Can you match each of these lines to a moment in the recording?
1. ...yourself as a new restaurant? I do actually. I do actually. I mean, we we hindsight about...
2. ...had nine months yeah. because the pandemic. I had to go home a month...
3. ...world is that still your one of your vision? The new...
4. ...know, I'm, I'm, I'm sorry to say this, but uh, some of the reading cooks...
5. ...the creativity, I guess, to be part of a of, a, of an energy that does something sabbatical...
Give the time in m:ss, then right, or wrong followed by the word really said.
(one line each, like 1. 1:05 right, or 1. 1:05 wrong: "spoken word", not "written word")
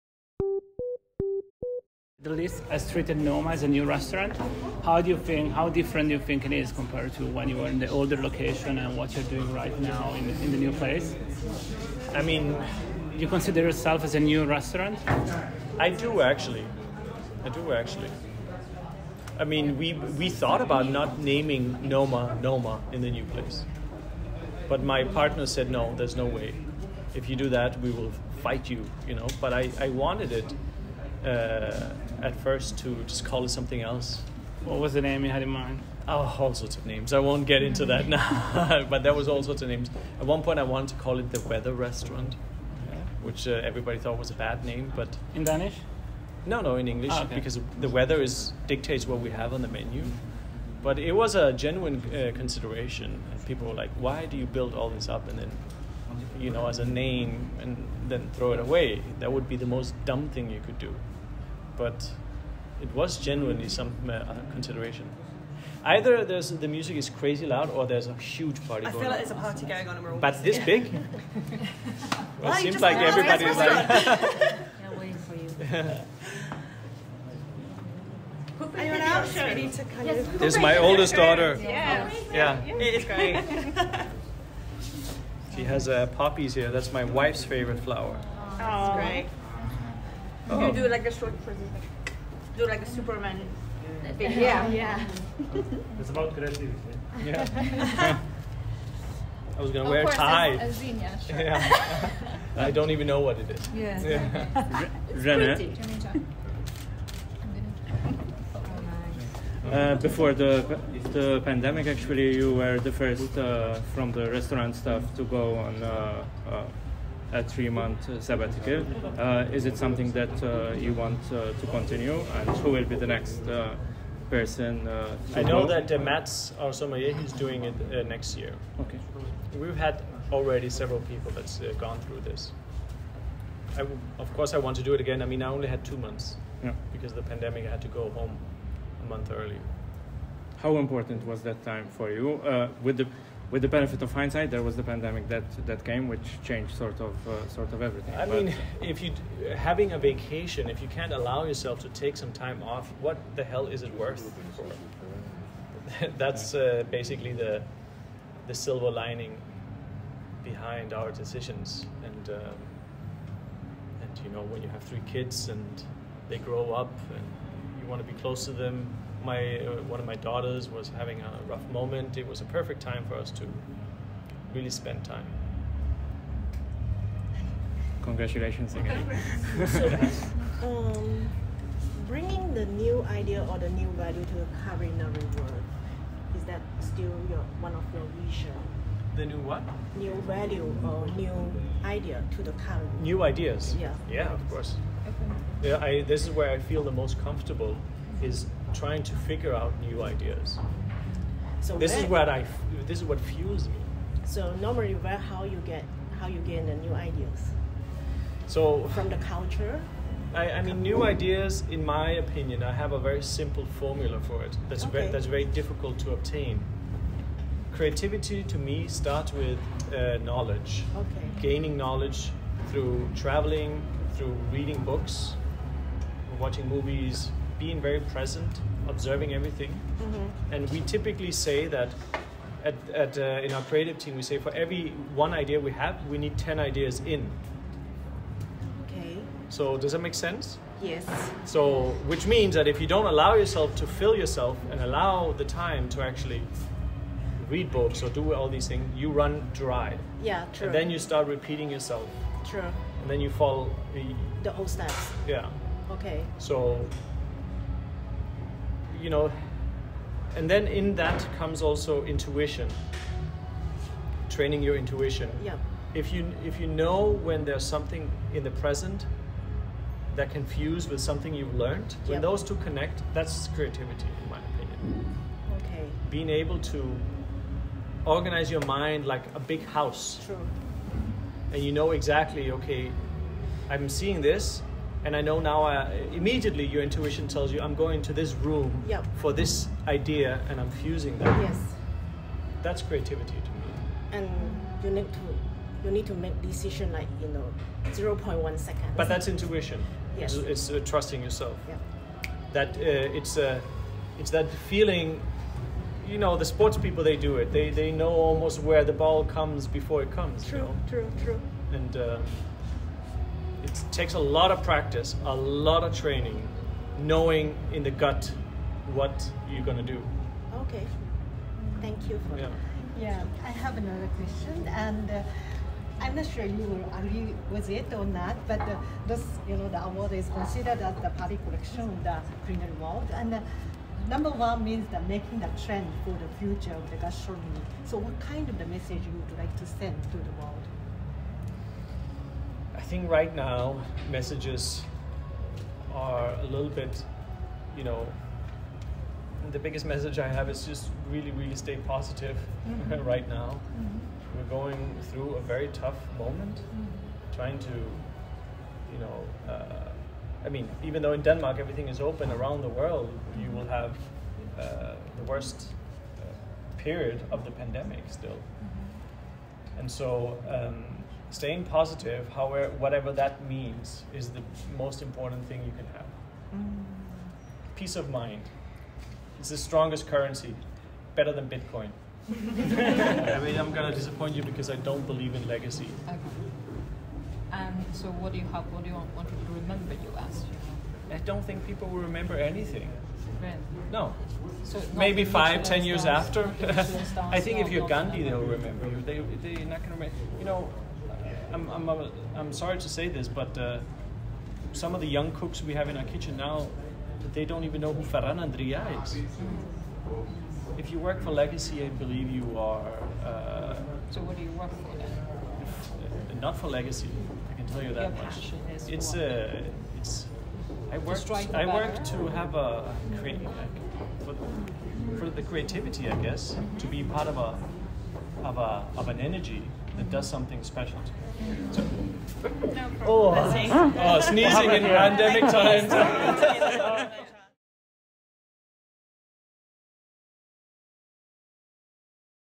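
1. 0:13 wrong: "thought", not "hindsight"
2. 2:15 wrong: "two", not "nine"
3. 3:05 right
4. 6:40 wrong: "young", not "reading"
5. 7:05 wrong: "special", not "sabbatical".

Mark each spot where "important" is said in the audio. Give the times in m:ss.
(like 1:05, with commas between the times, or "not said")
2:20, 6:15.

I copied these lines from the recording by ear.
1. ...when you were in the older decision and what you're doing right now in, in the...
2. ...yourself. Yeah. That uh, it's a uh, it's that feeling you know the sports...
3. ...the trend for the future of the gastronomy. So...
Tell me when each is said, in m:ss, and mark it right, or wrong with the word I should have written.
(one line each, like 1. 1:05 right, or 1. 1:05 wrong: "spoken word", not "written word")
1. 0:07 wrong: "location", not "decision"
2. 5:01 right
3. 5:35 right.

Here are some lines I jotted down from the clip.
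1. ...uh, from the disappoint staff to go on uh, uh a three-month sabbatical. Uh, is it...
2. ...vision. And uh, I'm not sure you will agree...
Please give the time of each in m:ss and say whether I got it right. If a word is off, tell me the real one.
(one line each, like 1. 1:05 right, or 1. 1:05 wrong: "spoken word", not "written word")
1. 1:53 wrong: "restaurant", not "disappoint"
2. 5:24 wrong: "question", not "vision".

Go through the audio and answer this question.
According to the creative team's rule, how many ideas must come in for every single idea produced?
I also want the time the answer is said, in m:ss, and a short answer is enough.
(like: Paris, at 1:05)
10, at 3:56.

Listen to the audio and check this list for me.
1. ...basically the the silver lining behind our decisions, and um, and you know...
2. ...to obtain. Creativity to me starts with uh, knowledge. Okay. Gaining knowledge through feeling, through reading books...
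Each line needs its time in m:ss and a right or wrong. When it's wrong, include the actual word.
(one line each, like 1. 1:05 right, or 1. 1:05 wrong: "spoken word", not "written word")
1. 2:36 right
2. 3:35 wrong: "traveling", not "feeling".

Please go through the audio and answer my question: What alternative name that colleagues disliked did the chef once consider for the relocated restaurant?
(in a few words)
the Weather Restaurant.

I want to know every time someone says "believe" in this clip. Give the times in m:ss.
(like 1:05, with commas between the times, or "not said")
6:25, 6:51.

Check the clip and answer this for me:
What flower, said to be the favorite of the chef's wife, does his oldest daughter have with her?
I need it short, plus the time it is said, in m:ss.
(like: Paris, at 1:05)
poppies, at 1:26.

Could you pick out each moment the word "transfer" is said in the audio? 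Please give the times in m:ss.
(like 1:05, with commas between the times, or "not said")
not said.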